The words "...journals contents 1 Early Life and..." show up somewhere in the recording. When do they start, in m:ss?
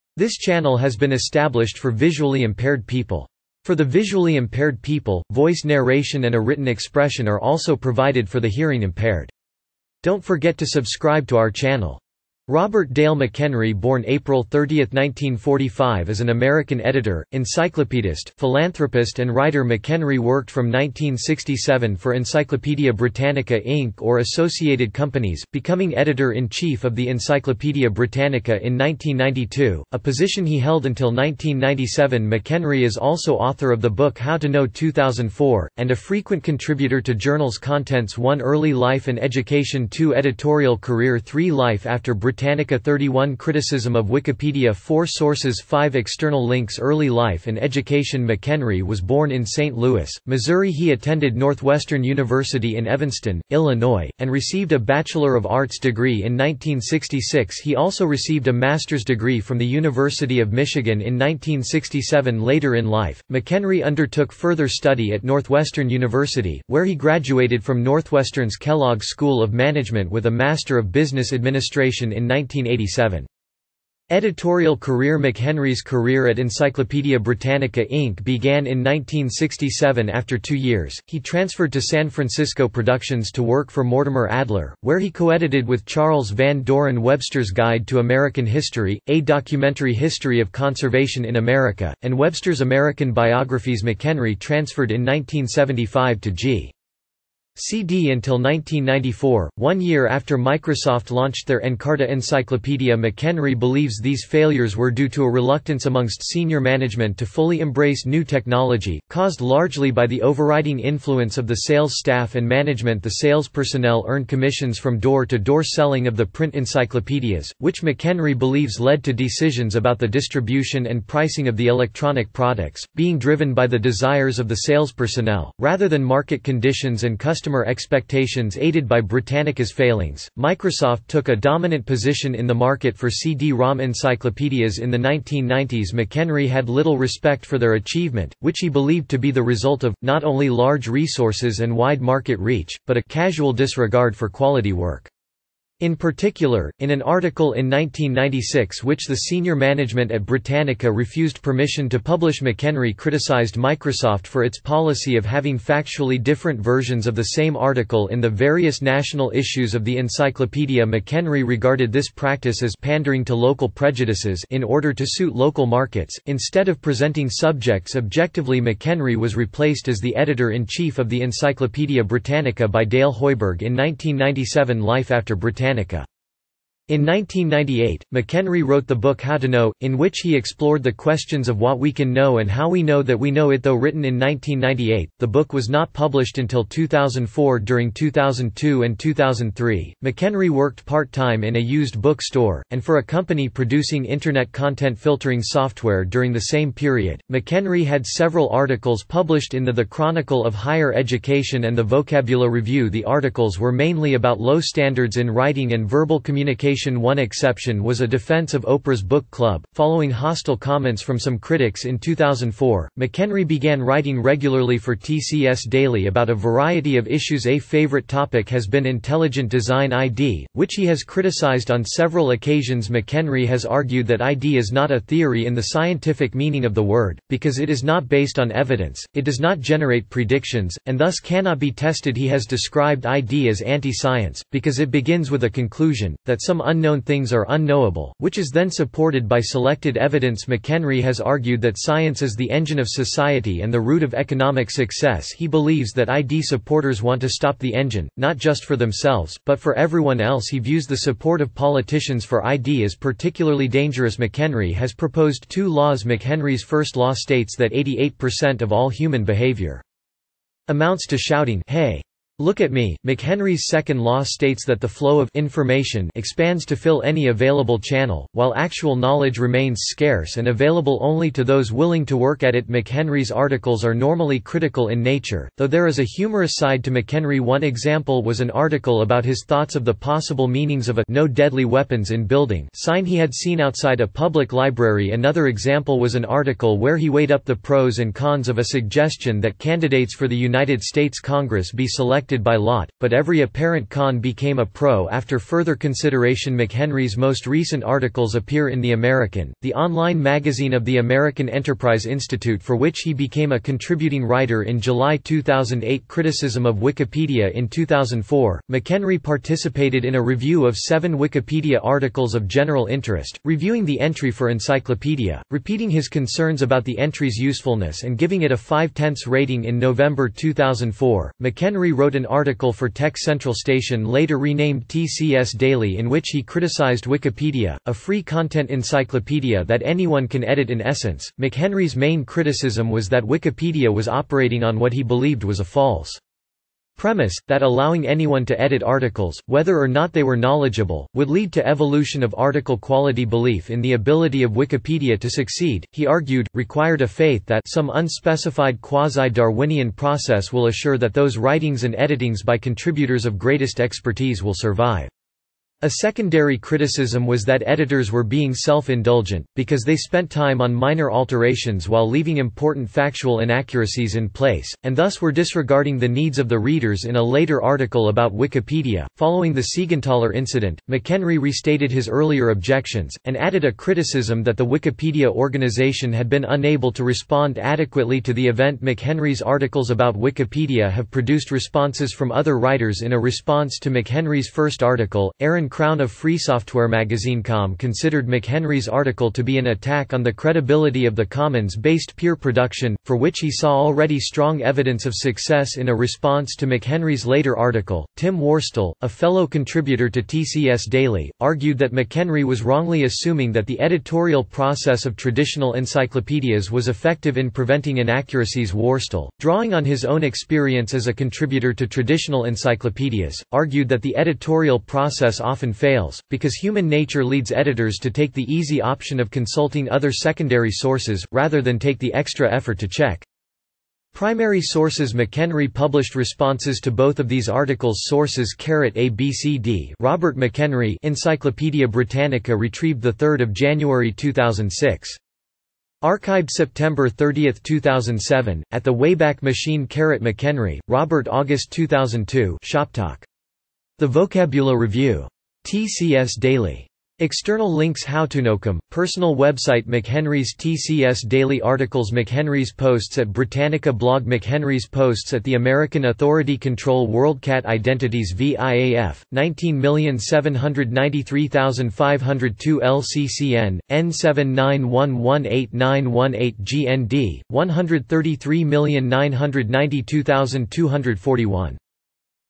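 0:37.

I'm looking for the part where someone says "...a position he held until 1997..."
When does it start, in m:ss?
0:29.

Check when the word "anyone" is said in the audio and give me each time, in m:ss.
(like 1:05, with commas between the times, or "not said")
5:29, 5:38.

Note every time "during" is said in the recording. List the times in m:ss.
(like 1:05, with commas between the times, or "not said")
3:07, 3:16.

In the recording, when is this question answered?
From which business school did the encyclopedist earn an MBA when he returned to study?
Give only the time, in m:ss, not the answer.
1:08.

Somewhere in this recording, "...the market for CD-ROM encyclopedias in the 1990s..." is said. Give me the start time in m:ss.
2:12.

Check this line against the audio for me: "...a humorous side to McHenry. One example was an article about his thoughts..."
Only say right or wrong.
right.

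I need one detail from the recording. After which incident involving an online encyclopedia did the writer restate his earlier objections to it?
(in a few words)
Siegenthaler incident.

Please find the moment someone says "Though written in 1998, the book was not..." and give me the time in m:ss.
3:03.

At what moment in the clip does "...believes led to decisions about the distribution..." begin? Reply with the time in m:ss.
1:58.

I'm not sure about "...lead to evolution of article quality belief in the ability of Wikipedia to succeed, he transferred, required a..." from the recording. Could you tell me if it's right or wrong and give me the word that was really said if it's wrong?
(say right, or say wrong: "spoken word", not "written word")
wrong: "argued", not "transferred".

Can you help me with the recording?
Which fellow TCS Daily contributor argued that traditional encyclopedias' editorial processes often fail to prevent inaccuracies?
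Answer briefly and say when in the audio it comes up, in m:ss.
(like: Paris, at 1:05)
Tim Worstall, at 6:38.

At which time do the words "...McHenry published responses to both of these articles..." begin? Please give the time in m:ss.
7:05.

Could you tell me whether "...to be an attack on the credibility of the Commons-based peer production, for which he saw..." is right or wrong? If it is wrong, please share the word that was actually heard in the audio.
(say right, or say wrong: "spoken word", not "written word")
right.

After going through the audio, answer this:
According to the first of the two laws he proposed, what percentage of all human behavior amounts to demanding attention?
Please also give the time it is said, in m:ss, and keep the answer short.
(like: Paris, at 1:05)
88%, at 4:17.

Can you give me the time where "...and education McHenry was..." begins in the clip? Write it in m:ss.
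0:47.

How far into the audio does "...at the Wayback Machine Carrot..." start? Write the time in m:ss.
7:18.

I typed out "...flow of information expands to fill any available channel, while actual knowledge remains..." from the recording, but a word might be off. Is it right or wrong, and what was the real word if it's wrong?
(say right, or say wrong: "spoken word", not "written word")
right.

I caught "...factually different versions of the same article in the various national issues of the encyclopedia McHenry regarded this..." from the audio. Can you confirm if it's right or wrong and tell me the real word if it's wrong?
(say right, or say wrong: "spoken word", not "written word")
right.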